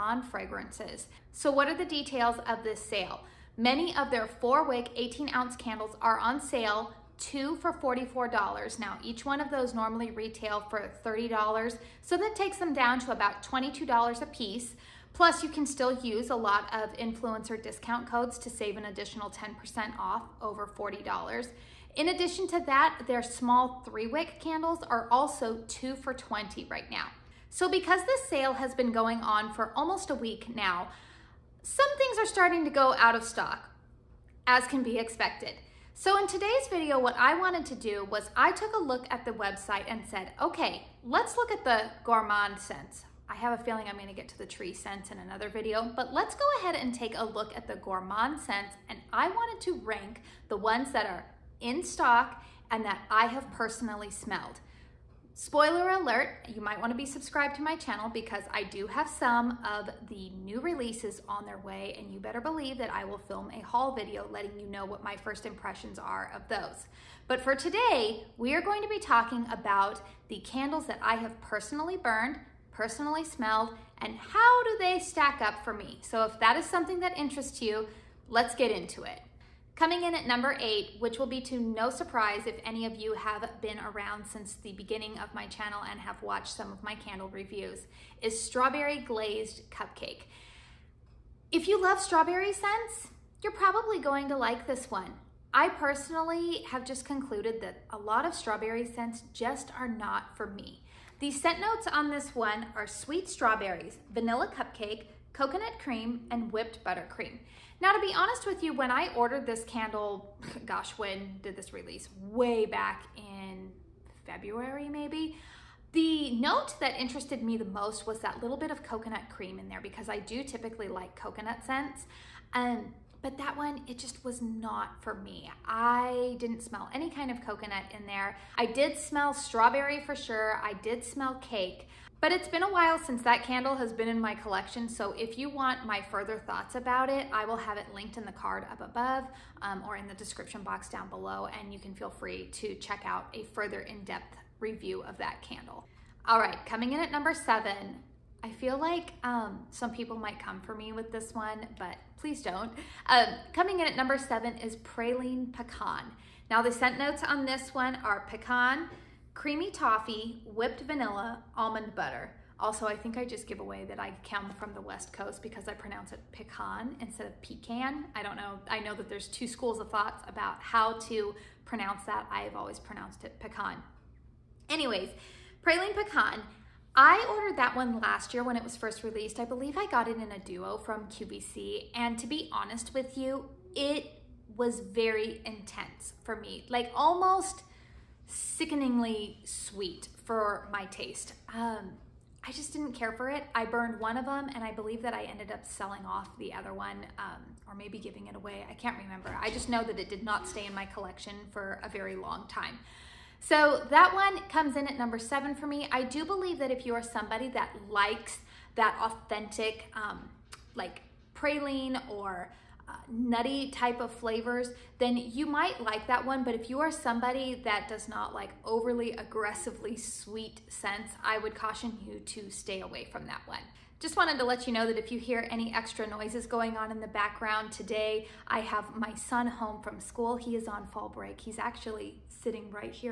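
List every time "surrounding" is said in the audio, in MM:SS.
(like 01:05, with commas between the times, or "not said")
not said.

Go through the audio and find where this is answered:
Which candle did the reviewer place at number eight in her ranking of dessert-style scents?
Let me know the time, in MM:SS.
01:28.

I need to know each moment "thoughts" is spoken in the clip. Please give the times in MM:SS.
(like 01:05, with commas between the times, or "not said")
02:16, 02:49.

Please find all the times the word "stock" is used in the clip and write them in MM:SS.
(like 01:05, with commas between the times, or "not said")
00:33, 00:51.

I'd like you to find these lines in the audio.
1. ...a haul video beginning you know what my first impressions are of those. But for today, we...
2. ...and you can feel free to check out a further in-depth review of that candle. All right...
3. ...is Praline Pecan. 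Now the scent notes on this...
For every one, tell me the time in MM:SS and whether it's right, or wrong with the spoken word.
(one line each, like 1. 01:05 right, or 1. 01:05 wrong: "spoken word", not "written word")
1. 01:03 wrong: "letting", not "beginning"
2. 02:21 right
3. 02:34 right.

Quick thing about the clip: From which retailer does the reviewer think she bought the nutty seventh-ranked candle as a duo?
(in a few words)
QVC.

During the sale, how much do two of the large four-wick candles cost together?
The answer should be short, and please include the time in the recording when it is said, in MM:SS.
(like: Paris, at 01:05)
$44, at 00:07.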